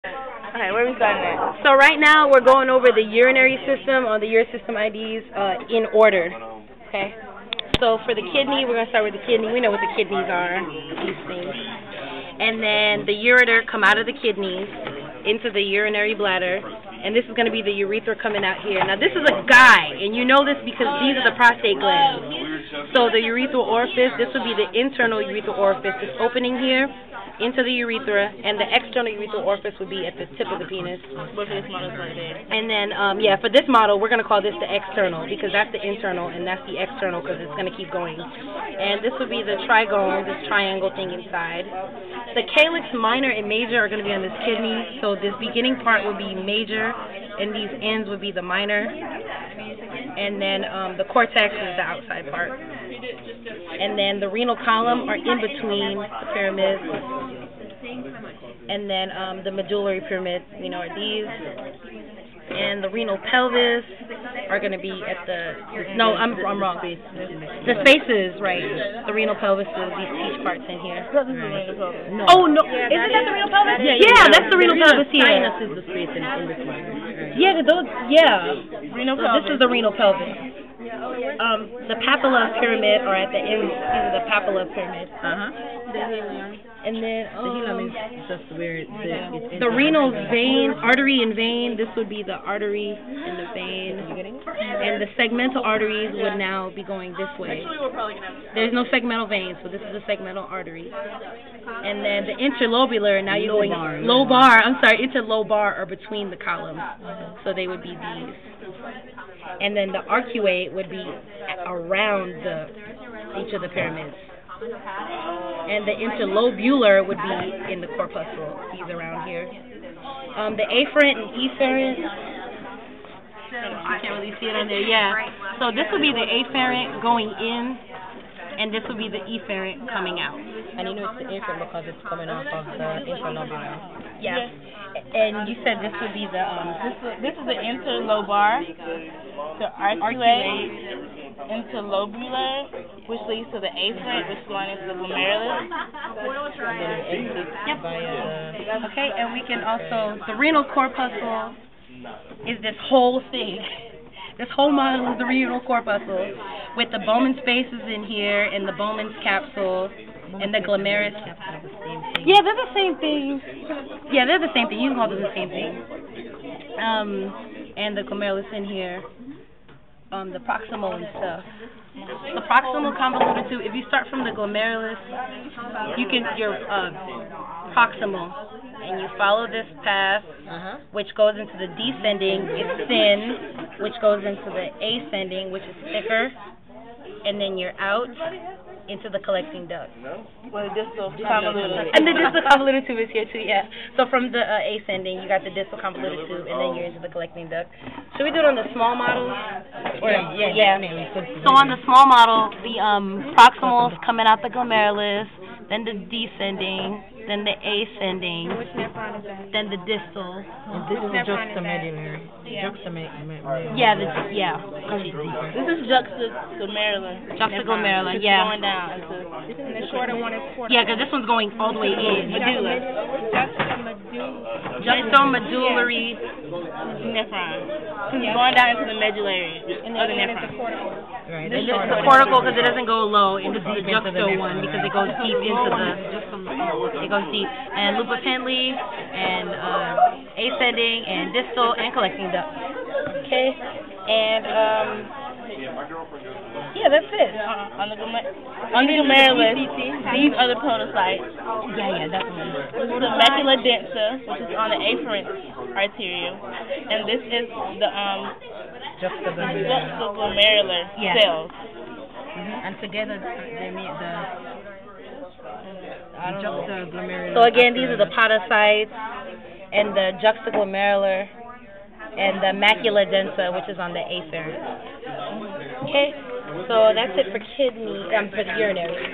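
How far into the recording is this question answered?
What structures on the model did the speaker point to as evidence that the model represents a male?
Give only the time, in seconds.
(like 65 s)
21 s.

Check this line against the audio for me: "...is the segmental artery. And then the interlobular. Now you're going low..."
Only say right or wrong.
right.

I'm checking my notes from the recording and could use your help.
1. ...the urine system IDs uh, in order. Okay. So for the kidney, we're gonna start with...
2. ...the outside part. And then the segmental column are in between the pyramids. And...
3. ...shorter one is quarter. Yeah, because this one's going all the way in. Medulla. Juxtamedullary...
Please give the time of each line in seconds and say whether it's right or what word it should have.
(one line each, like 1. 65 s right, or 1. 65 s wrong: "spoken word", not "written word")
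1. 4 s right
2. 51 s wrong: "renal", not "segmental"
3. 219 s right.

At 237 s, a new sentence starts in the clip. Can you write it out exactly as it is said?
And Loop of Henle and uh, ascending and distal and collecting duct.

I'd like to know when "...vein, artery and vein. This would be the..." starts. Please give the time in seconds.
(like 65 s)
90 s.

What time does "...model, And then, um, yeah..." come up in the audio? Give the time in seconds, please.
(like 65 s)
31 s.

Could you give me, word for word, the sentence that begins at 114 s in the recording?
And the interlobular would be in the corpuscle.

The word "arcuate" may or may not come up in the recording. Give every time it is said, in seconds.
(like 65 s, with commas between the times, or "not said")
110 s, 139 s.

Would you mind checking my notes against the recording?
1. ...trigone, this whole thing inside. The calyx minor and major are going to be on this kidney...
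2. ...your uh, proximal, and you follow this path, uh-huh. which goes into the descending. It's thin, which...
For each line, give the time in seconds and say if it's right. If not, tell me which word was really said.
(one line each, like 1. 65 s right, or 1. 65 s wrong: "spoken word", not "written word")
1. 39 s wrong: "triangle", not "whole"
2. 176 s right.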